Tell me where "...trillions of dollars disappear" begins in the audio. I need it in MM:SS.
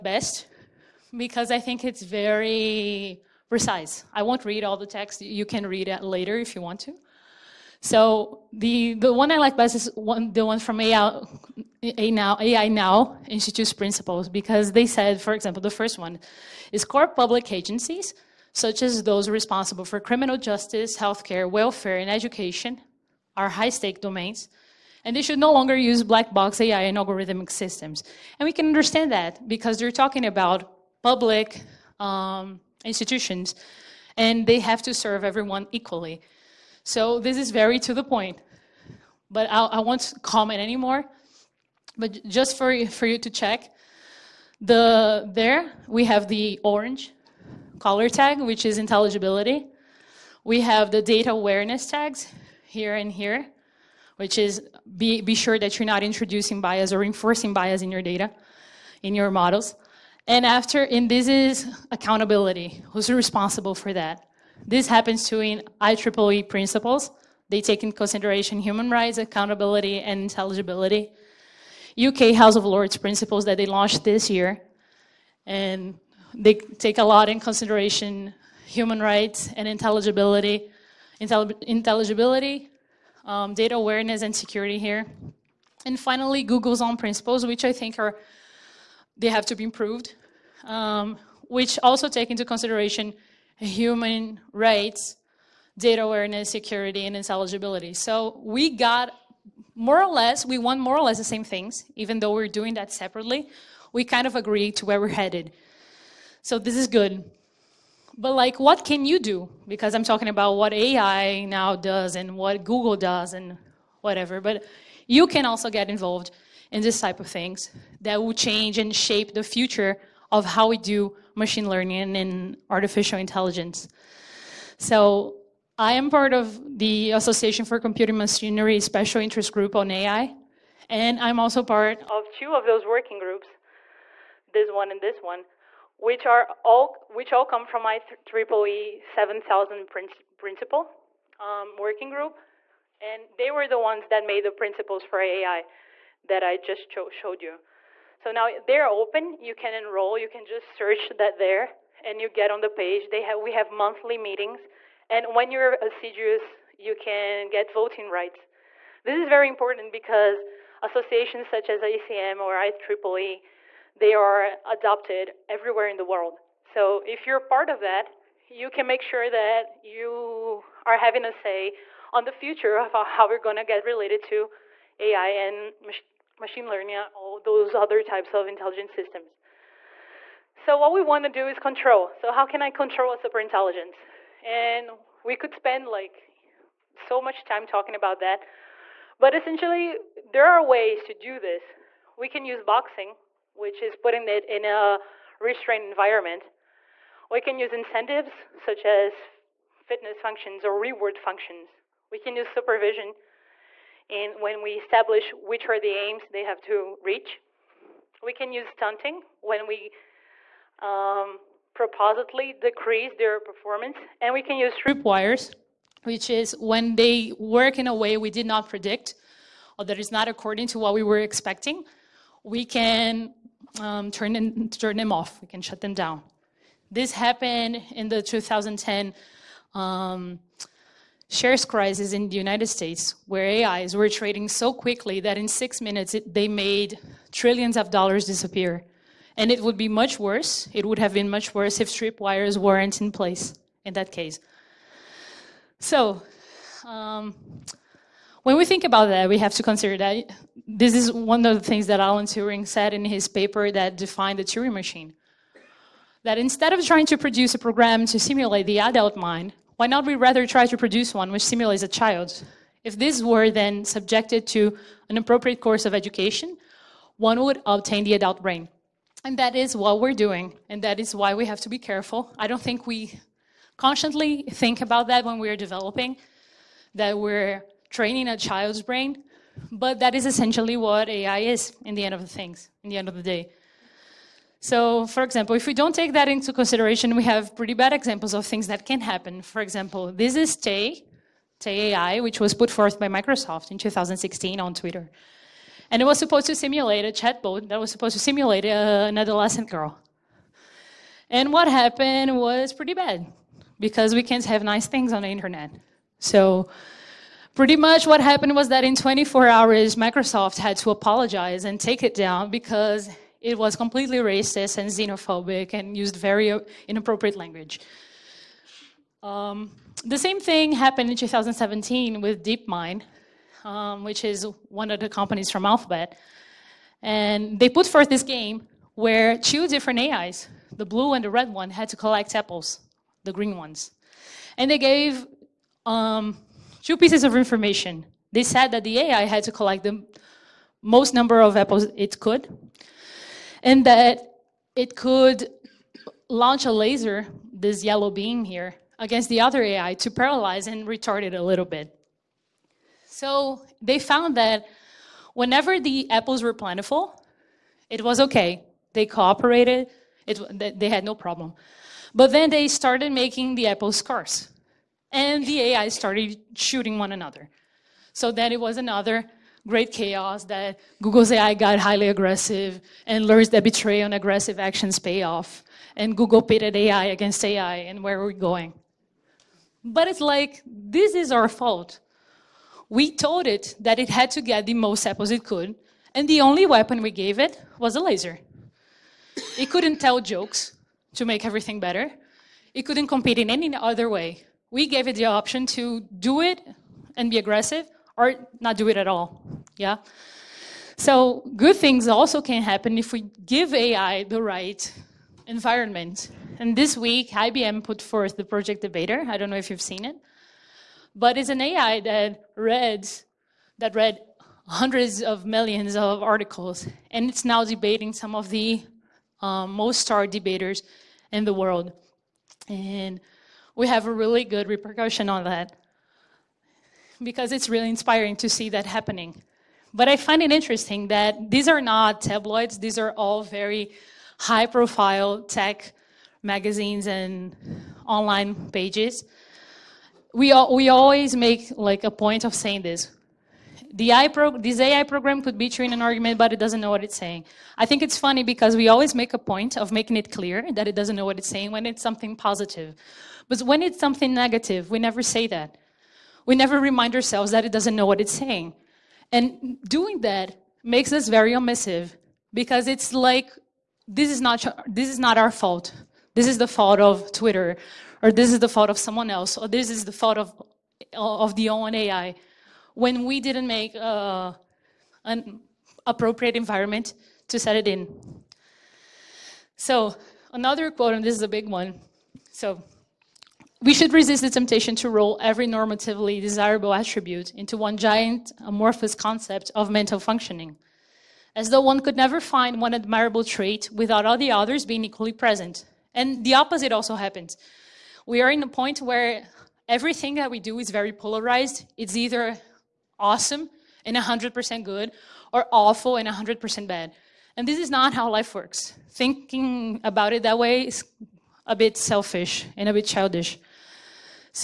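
03:57.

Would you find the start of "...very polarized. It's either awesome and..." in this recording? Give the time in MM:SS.
08:20.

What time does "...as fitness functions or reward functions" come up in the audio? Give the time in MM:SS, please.
03:18.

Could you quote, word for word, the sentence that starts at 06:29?
It couldn't tell jokes to make everything better.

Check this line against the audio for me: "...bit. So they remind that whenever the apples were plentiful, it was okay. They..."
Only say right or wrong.
wrong.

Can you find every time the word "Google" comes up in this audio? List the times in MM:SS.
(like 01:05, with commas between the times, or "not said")
01:26, 01:52, 06:11, 06:16.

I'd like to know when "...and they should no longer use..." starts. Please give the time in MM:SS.
00:25.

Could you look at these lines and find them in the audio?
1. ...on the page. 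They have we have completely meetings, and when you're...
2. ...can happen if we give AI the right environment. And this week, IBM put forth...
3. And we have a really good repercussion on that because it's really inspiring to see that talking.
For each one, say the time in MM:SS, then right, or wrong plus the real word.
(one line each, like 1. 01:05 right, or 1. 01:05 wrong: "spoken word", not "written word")
1. 02:32 wrong: "monthly", not "completely"
2. 06:42 right
3. 07:02 wrong: "happening", not "talking".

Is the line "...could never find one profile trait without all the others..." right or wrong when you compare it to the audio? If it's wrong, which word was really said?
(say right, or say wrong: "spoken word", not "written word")
wrong: "admirable", not "profile".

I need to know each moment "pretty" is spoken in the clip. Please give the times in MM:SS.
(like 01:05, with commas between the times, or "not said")
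04:47, 05:02, 05:07.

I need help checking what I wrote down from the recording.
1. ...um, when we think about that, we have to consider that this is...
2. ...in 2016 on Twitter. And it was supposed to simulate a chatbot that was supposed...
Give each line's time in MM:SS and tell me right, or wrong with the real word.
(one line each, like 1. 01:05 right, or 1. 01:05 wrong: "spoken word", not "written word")
1. 04:06 right
2. 04:53 right.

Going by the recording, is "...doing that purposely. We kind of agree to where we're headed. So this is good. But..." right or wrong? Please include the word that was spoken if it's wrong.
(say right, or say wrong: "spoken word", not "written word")
wrong: "separately", not "purposely".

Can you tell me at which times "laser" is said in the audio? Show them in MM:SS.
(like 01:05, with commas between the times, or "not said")
05:46, 06:27.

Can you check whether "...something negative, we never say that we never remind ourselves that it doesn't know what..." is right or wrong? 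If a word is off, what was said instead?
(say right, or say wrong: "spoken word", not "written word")
right.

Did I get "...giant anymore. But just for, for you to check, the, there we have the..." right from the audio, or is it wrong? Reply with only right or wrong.
wrong.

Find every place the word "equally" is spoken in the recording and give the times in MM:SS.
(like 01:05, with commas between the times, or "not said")
00:35, 08:15.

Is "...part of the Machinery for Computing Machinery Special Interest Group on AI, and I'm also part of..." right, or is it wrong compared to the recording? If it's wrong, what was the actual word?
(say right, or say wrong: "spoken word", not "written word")
wrong: "Association", not "Machinery".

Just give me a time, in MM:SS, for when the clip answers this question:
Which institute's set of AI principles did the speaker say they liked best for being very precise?
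00:12.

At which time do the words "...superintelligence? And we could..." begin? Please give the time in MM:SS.
03:03.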